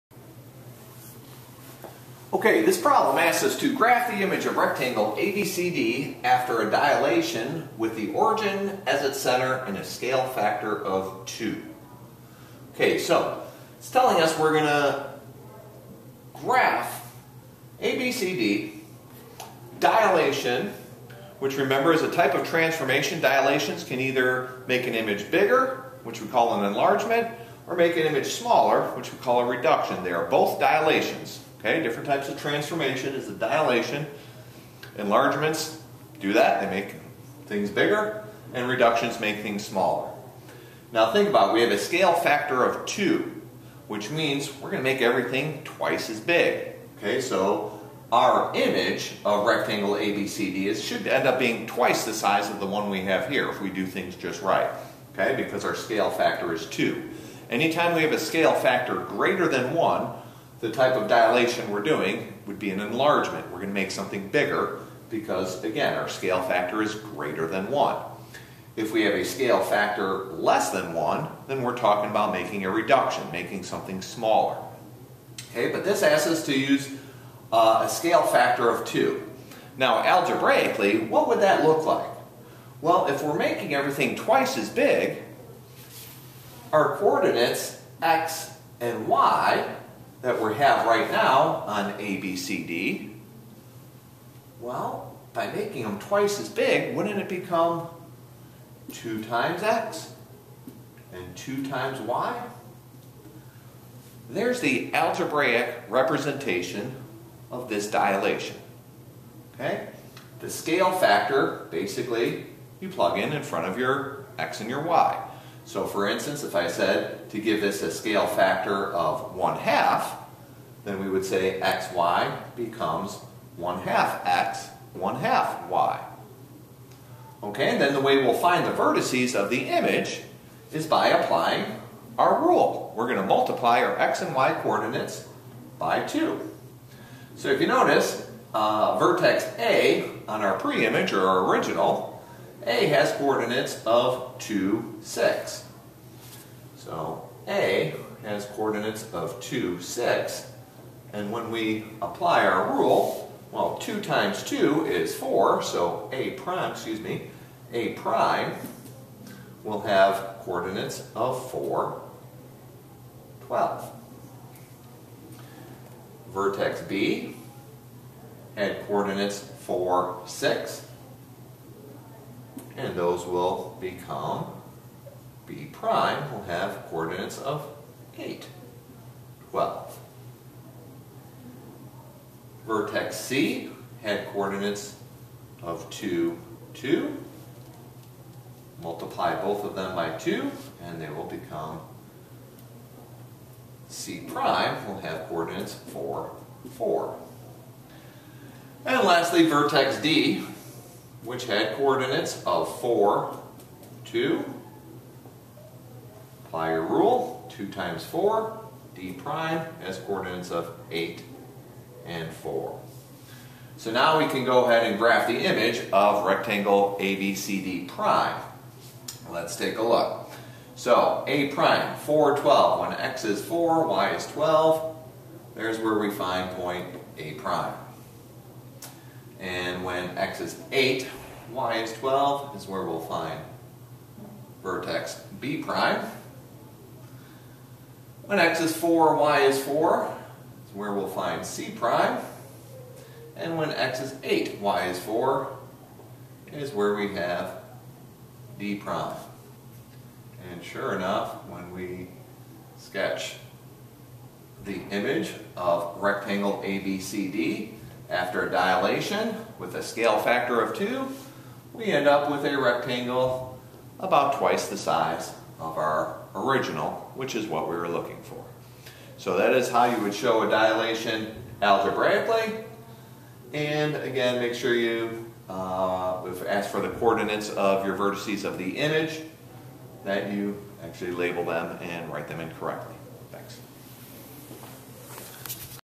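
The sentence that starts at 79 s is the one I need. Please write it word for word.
Now, algebraically, what would that look like?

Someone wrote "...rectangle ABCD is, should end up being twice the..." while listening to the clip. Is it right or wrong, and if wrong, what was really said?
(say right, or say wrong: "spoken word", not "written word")
right.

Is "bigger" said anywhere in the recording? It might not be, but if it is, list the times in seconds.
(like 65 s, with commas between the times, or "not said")
25 s, 37 s, 64 s.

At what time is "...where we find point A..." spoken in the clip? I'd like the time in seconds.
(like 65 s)
225 s.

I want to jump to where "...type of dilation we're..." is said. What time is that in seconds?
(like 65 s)
60 s.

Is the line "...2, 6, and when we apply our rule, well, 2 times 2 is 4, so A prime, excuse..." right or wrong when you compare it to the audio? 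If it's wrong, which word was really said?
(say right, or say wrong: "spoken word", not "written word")
right.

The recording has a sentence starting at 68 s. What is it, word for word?
If we have a scale factor less than 1, then we're talking about making a reduction, making something smaller.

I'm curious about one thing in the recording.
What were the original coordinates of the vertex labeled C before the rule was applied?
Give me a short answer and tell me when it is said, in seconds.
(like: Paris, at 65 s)
(2, 2), at 185 s.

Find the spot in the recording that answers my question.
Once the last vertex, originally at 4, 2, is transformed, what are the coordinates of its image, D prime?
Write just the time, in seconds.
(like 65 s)
210 s.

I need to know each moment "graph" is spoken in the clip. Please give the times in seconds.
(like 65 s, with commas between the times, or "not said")
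3 s, 16 s, 214 s.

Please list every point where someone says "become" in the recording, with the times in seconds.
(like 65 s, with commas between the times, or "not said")
97 s, 122 s, 173 s, 191 s.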